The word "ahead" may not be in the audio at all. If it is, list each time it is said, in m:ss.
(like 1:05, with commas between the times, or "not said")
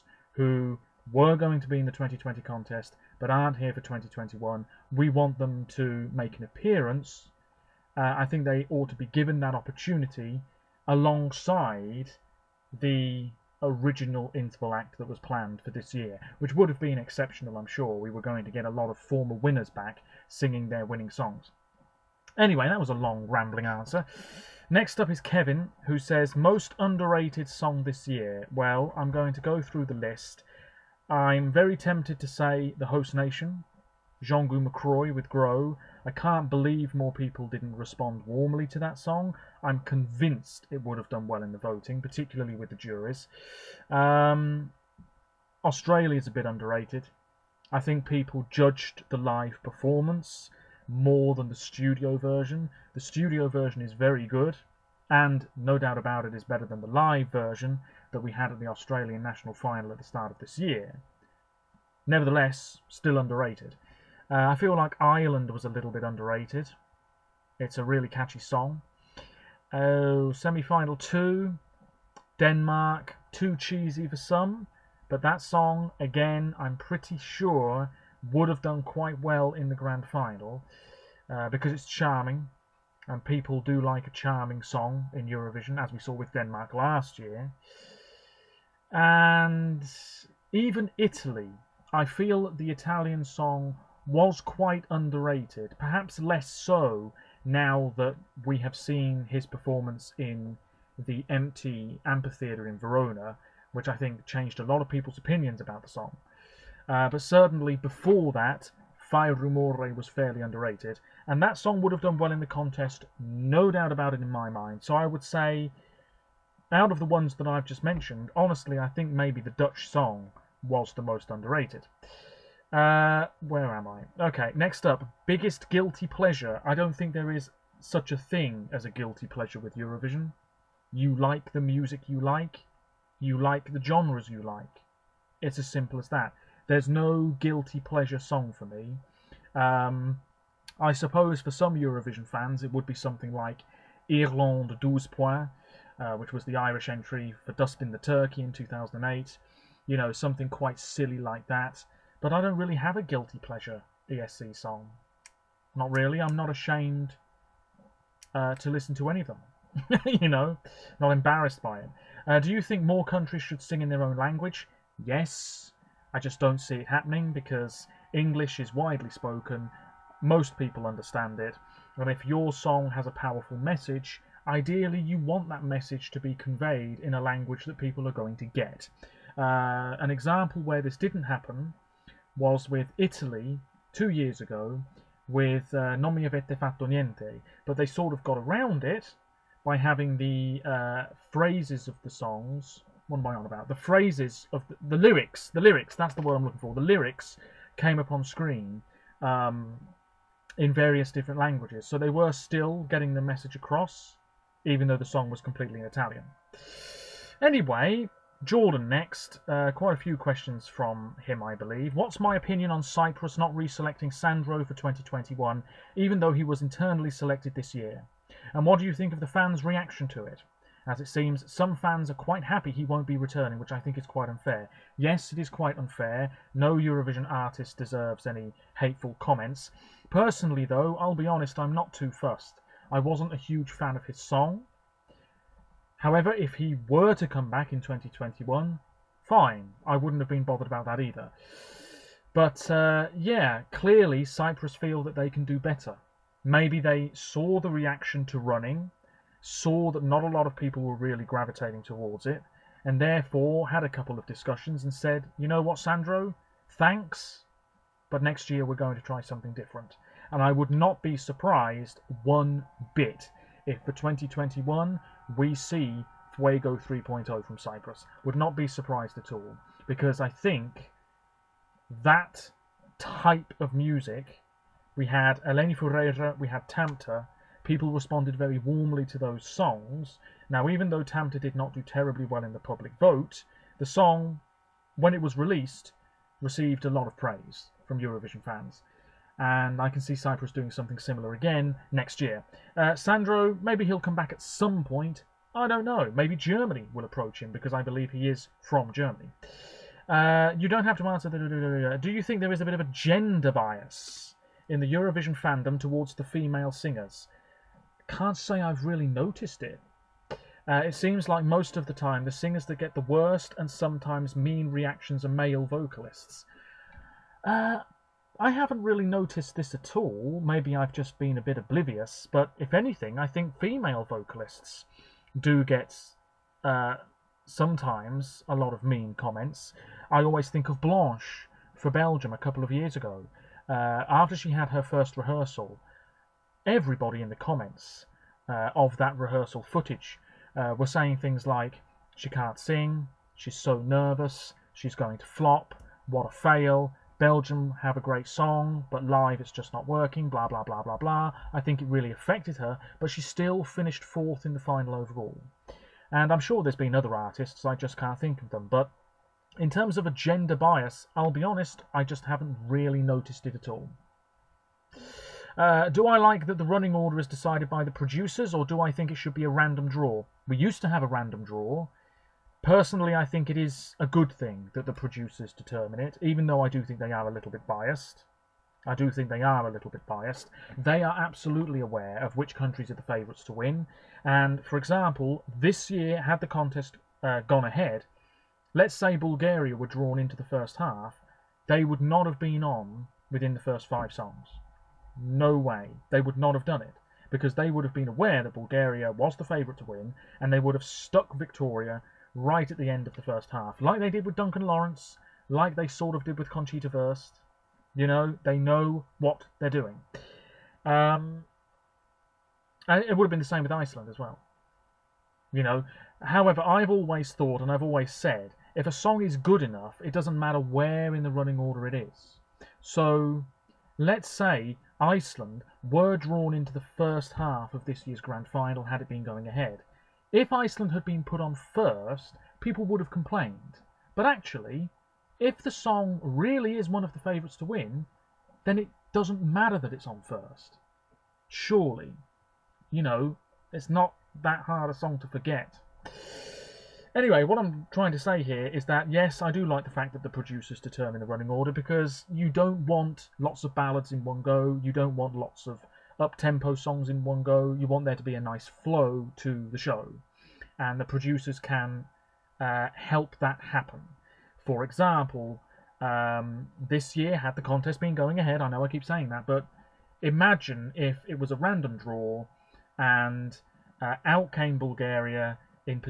6:27, 7:09, 7:48.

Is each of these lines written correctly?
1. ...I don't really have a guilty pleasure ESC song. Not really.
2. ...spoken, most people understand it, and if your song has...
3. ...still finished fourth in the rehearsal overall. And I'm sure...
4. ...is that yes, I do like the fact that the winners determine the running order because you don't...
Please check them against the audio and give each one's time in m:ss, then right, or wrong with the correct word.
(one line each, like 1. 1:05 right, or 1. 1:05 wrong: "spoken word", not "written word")
1. 2:32 right
2. 2:49 right
3. 5:53 wrong: "final", not "rehearsal"
4. 7:28 wrong: "producers", not "winners".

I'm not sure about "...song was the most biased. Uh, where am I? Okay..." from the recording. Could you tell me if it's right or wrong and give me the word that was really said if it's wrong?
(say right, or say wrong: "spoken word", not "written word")
wrong: "underrated", not "biased".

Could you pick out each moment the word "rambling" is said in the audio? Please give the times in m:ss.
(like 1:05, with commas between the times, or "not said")
0:23.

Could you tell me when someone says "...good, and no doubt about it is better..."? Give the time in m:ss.
0:54.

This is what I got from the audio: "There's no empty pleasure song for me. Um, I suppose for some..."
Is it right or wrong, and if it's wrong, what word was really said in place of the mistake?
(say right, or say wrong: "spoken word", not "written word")
wrong: "guilty", not "empty".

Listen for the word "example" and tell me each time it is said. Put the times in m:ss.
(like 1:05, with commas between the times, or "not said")
3:00, 6:24, 7:44.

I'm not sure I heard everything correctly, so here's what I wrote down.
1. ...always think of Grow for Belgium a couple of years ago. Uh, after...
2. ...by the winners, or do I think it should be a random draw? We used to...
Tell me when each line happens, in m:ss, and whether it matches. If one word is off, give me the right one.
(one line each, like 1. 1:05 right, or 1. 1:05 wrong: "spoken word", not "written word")
1. 5:30 wrong: "Blanche", not "Grow"
2. 6:07 wrong: "producers", not "winners".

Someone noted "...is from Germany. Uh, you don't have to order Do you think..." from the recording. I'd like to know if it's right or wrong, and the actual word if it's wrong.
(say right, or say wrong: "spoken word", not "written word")
wrong: "answer", not "order".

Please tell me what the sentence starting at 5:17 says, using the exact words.
Uh, I haven't really noticed this at all.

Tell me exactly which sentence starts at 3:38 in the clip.
And what do you think of the fans' reaction to it?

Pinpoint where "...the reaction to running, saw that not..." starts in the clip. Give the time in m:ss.
4:07.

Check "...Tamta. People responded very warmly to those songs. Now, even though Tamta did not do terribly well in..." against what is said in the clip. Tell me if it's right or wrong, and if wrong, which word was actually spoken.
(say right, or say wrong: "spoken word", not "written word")
right.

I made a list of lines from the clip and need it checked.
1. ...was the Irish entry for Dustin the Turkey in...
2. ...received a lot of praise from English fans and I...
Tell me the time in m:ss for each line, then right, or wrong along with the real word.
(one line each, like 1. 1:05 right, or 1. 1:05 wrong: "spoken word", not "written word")
1. 2:26 right
2. 4:46 wrong: "Eurovision", not "English".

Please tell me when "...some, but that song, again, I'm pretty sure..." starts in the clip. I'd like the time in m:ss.
1:14.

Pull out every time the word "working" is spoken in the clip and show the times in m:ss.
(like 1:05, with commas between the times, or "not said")
5:49.